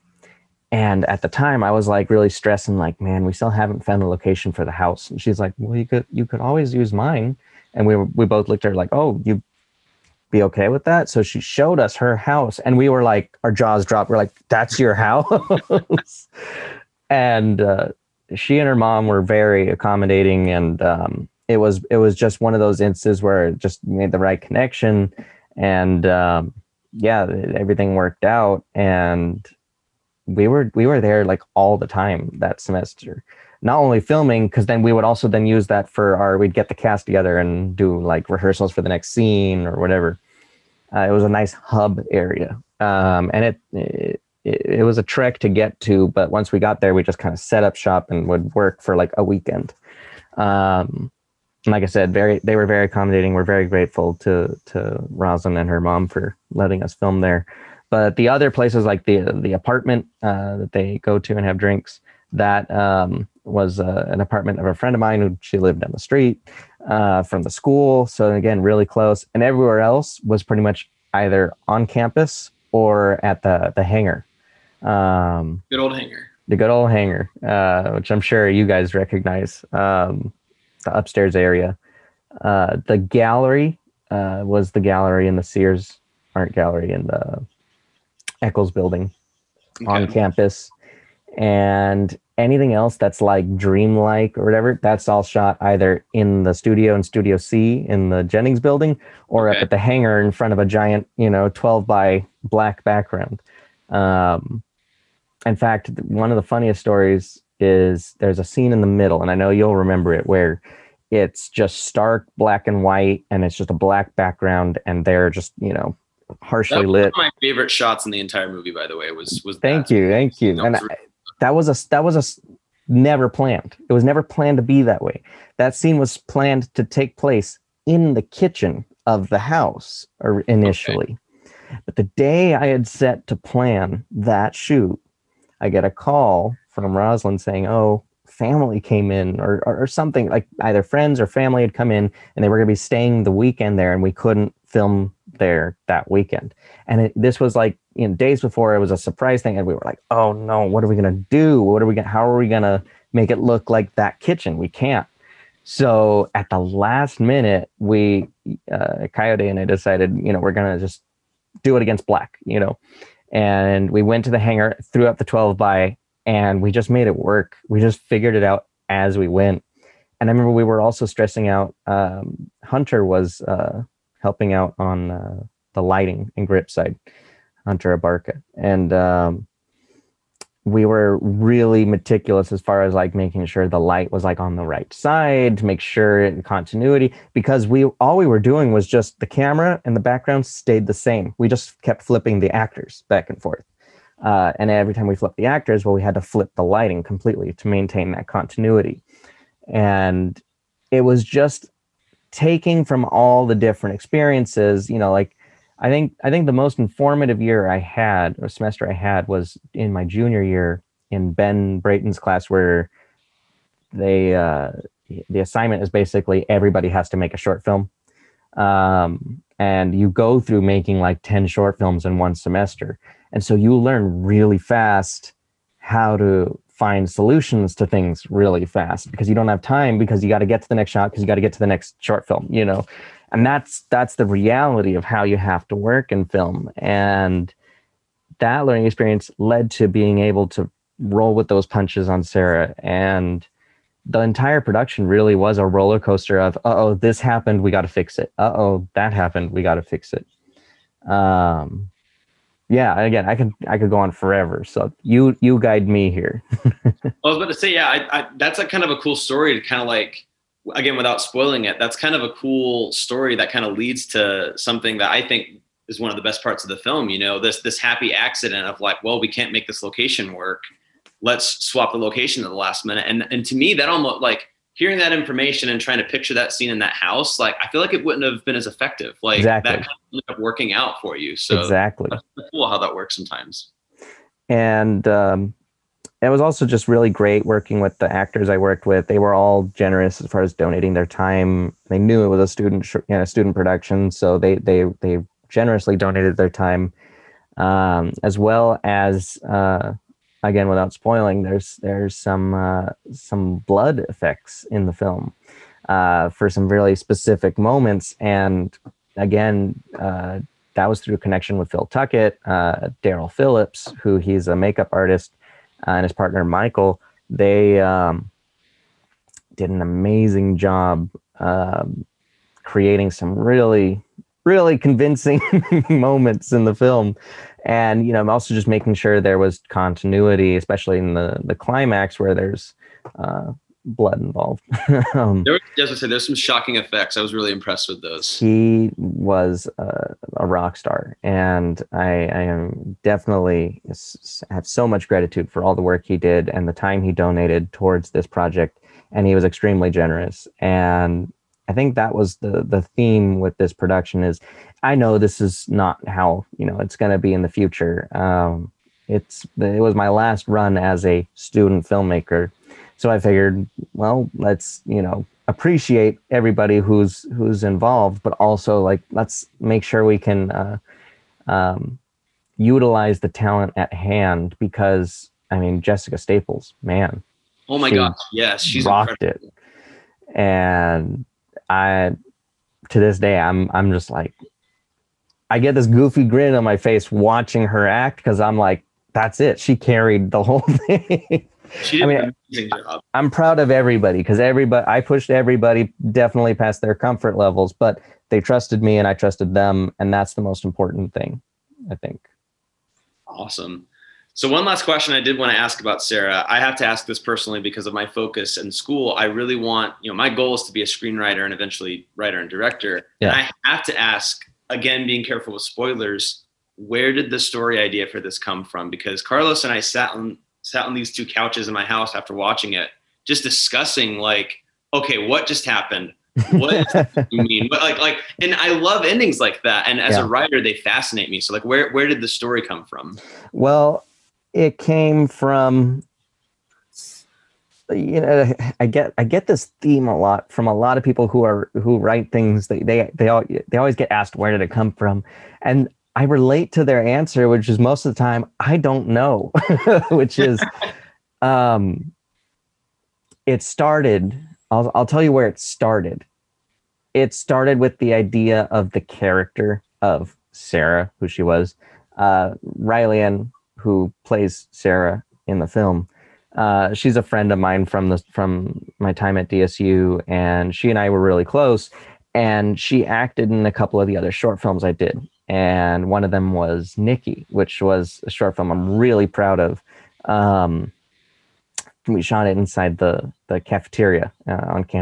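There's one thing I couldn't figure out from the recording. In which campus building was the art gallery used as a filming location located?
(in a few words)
Eccles building.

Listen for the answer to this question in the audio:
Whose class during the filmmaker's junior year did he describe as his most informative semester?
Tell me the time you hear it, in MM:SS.
03:31.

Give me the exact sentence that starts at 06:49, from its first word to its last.
I really want, you know, my goal is to be a screenwriter and eventually writer and director.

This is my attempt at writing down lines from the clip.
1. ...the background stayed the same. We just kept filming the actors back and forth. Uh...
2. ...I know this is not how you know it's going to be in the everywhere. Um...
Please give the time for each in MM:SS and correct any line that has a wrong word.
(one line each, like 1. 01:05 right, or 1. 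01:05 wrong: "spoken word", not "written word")
1. 03:09 wrong: "flipping", not "filming"
2. 05:54 wrong: "future", not "everywhere".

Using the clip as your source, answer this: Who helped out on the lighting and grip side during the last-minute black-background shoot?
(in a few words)
Hunter Abarca.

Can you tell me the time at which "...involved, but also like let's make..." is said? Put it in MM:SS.
06:07.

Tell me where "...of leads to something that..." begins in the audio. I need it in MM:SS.
04:23.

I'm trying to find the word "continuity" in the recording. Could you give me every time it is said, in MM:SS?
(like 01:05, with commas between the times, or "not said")
03:06, 03:18, 05:29.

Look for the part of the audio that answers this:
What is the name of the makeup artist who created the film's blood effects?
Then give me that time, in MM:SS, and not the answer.
05:13.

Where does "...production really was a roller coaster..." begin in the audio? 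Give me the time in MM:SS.
04:04.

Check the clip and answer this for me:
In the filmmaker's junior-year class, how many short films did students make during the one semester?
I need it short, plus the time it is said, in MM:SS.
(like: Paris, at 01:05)
10, at 03:41.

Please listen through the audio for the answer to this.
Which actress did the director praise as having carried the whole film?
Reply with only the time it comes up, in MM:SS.
06:15.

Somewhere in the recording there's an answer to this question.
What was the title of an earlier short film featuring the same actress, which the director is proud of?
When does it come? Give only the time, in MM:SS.
07:56.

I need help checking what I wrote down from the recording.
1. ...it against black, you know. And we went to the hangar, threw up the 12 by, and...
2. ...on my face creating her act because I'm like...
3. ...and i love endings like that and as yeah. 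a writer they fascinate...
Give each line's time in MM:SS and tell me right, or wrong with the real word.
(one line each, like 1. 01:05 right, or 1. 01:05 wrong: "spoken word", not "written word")
1. 02:41 right
2. 06:26 wrong: "watching", not "creating"
3. 07:08 right.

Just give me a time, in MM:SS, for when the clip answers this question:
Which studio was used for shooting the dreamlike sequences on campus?
01:37.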